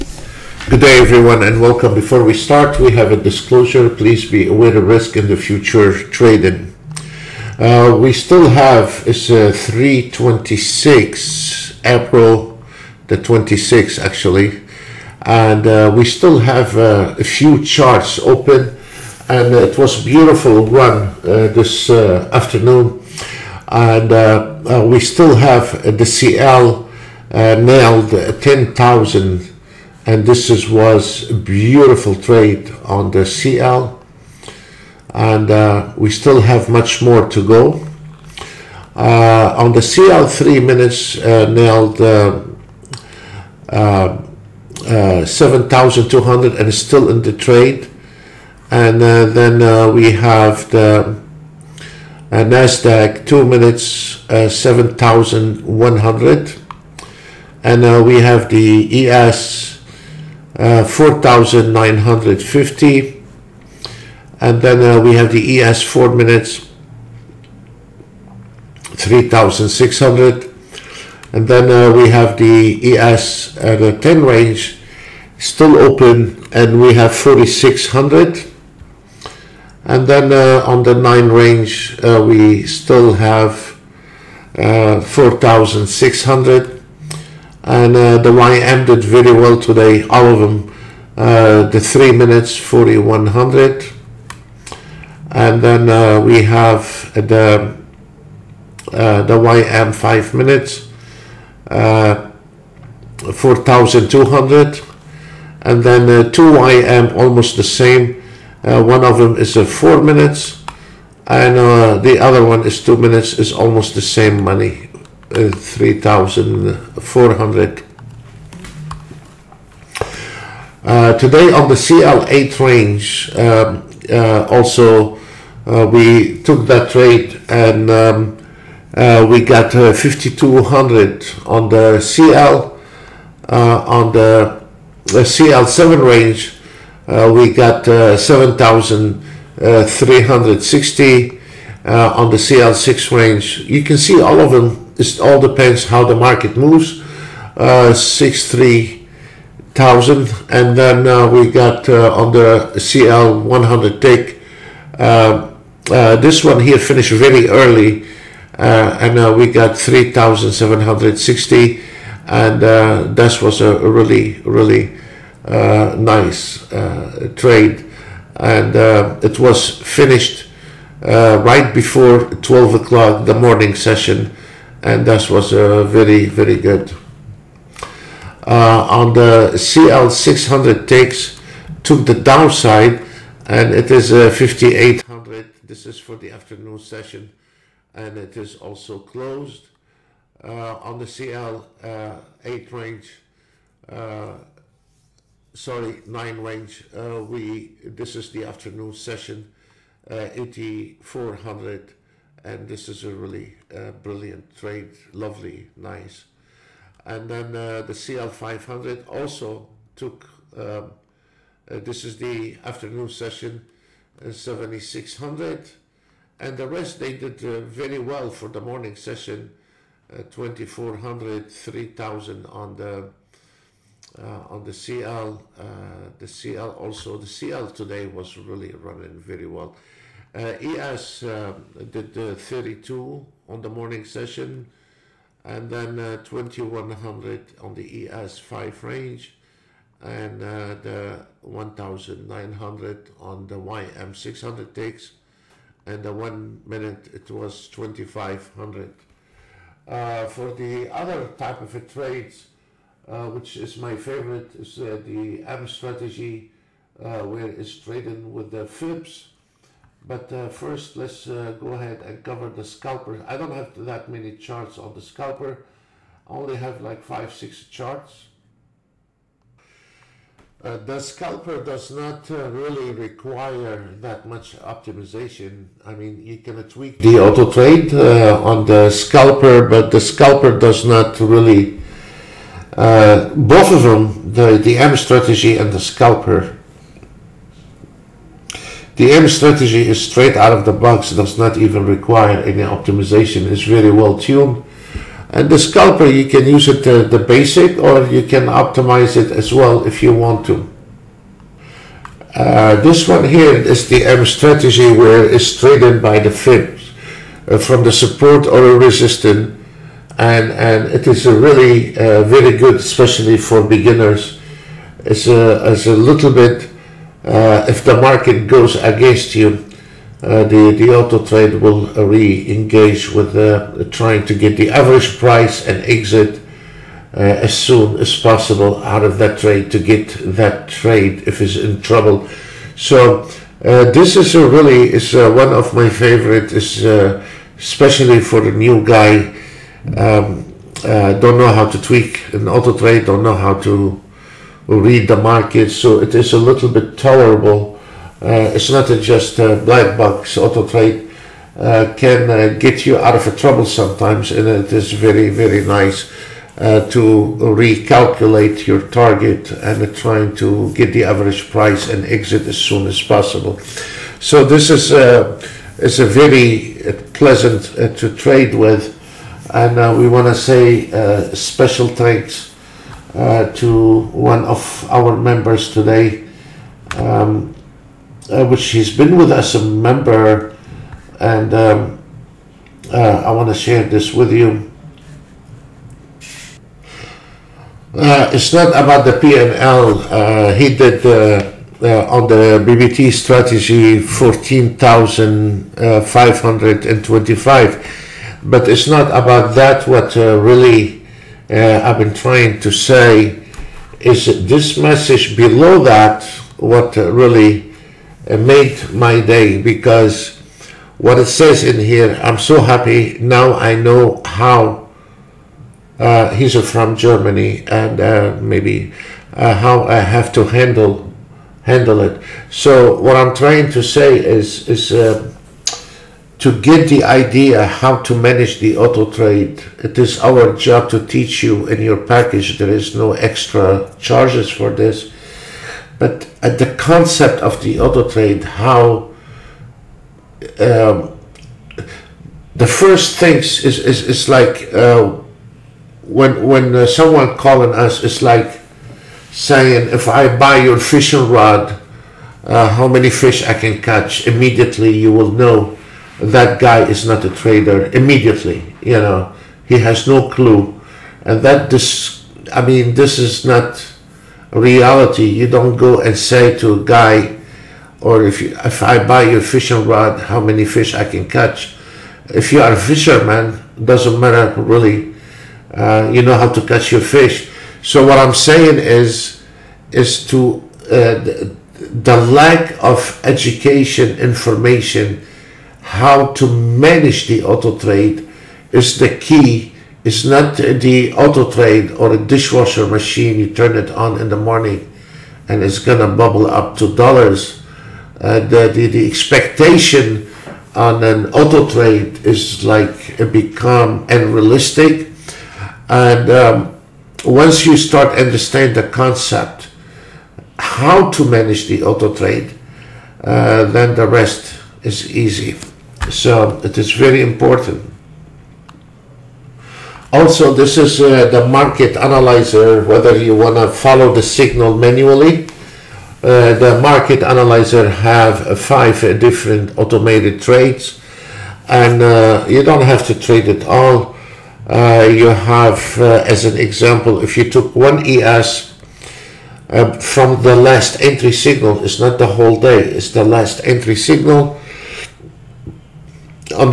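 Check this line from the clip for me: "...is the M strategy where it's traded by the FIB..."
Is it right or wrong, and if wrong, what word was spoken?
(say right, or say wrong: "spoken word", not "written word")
right.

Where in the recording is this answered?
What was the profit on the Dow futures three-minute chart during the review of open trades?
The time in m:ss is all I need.
1:32.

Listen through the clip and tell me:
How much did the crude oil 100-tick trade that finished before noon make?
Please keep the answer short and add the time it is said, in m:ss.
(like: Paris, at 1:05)
3,760, at 2:39.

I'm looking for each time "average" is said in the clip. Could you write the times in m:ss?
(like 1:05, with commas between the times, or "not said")
5:24, 6:01.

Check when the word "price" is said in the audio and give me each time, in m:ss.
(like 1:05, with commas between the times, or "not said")
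5:25, 6:01.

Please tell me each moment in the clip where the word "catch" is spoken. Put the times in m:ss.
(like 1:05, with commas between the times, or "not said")
7:33, 7:51, 7:56.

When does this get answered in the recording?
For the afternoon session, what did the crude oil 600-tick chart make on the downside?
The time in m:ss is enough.
3:04.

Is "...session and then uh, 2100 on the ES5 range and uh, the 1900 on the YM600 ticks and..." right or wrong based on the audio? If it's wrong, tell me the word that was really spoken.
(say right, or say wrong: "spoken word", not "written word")
right.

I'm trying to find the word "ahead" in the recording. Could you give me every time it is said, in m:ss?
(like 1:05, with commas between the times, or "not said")
4:21.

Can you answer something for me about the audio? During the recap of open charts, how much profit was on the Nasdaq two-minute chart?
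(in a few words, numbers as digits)
7,100.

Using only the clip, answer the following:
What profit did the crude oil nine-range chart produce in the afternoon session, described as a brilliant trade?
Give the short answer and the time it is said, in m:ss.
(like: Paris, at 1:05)
8,400, at 3:20.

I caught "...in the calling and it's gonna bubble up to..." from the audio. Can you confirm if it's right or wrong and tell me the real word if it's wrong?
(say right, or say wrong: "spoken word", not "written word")
wrong: "morning", not "calling".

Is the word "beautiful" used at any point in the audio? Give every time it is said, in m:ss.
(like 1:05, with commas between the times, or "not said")
0:20, 0:31.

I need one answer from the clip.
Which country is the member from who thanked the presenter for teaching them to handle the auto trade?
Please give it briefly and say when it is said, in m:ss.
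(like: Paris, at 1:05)
Germany, at 6:56.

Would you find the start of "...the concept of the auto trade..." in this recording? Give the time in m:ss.
7:16.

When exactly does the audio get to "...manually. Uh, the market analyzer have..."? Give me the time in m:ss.
8:44.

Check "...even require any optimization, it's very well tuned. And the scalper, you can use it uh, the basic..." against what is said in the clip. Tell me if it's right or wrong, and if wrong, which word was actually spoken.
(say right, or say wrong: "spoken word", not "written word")
right.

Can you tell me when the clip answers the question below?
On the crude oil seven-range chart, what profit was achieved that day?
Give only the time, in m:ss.
2:17.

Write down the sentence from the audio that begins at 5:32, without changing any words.
So uh, this is really is one of my favorite, is especially for the new guy.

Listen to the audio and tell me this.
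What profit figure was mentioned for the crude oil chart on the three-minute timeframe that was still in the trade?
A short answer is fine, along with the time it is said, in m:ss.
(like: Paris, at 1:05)
7,200, at 0:45.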